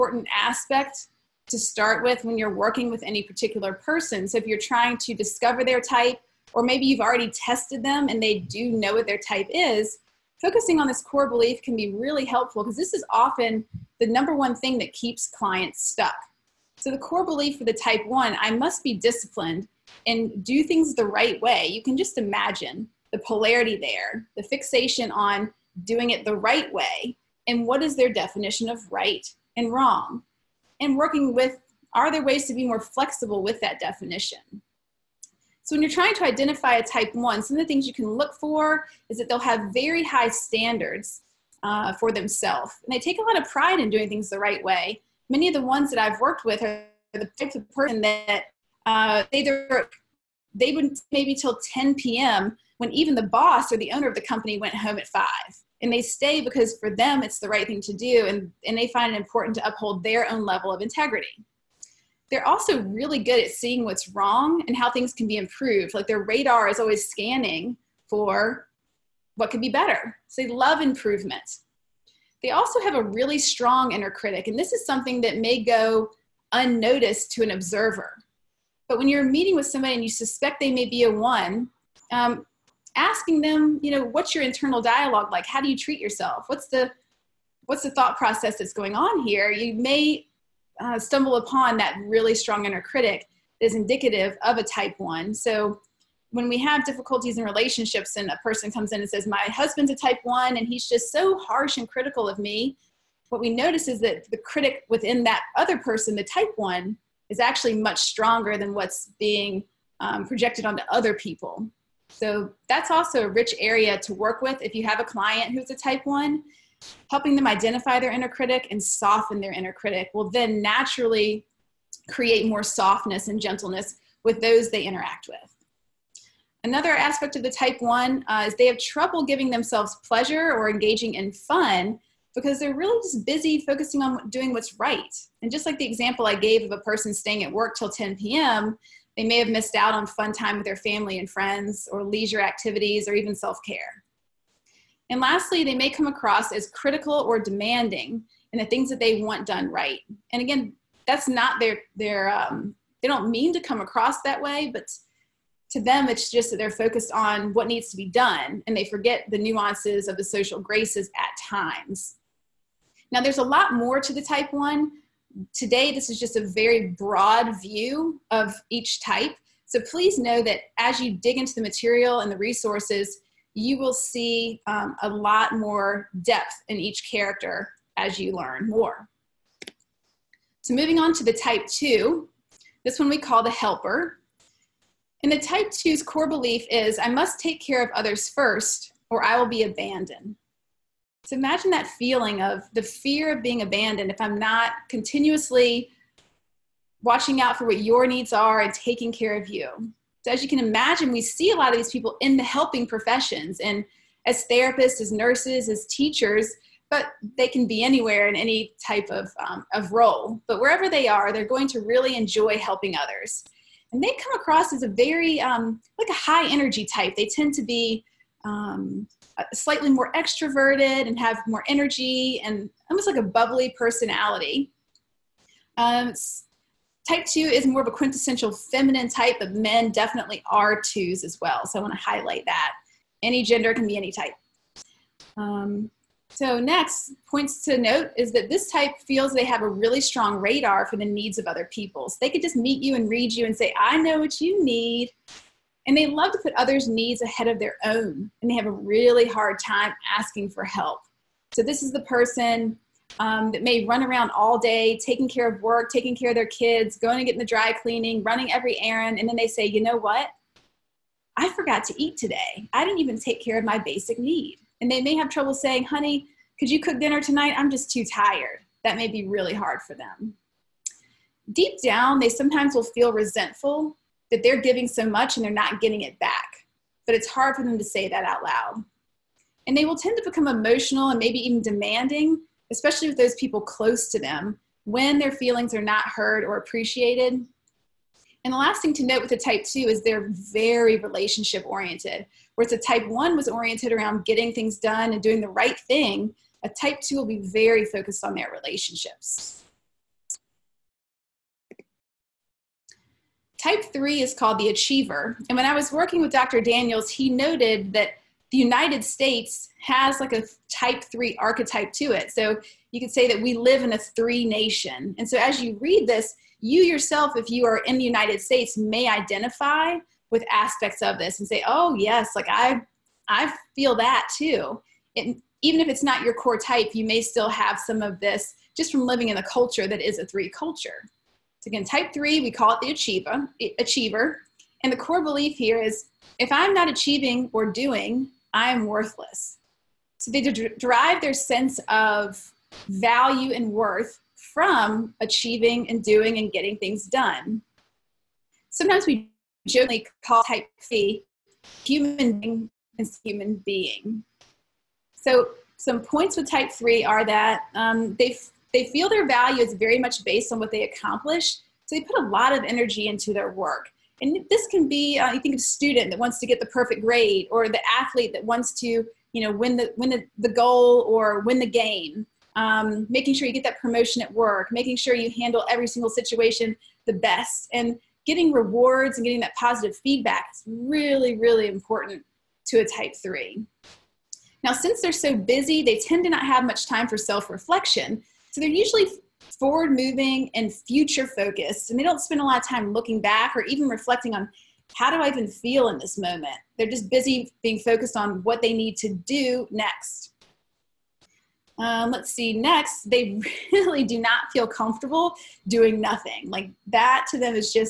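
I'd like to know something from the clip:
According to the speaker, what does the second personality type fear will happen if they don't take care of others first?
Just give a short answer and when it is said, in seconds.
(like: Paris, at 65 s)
Being abandoned, at 189 s.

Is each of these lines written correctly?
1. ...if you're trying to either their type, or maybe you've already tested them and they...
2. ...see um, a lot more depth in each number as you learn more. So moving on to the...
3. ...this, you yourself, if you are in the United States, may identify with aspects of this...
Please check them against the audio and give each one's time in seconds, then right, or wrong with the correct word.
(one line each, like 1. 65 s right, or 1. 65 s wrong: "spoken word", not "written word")
1. 4 s wrong: "discover", not "either"
2. 173 s wrong: "character", not "number"
3. 316 s right.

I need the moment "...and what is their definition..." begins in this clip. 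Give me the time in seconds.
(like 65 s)
27 s.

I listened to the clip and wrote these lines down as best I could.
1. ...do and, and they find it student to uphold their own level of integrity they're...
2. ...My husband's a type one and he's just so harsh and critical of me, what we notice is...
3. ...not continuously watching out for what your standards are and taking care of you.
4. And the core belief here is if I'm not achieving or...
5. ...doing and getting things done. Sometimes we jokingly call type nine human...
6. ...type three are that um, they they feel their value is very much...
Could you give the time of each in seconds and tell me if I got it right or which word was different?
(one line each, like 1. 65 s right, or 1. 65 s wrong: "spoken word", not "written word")
1. 57 s wrong: "important", not "student"
2. 99 s right
3. 194 s wrong: "needs", not "standards"
4. 334 s right
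5. 346 s wrong: "three", not "nine"
6. 356 s right.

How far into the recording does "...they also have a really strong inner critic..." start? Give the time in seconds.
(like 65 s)
72 s.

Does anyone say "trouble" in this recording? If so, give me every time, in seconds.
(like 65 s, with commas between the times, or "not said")
128 s, 265 s.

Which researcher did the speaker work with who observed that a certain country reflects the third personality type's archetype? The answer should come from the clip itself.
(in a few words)
Dr. Daniels.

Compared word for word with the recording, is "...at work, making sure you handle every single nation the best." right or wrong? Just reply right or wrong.
wrong.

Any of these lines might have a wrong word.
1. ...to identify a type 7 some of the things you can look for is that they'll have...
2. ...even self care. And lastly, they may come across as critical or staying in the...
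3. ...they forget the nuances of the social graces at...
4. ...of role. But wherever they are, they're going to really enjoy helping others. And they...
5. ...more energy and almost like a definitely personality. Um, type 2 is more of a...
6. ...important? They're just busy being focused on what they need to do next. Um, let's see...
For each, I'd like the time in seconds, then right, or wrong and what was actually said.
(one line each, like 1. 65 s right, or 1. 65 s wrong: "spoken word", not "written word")
1. 36 s wrong: "1", not "7"
2. 143 s wrong: "demanding", not "staying"
3. 158 s right
4. 209 s right
5. 221 s wrong: "bubbly", not "definitely"
6. 396 s wrong: "moment", not "important".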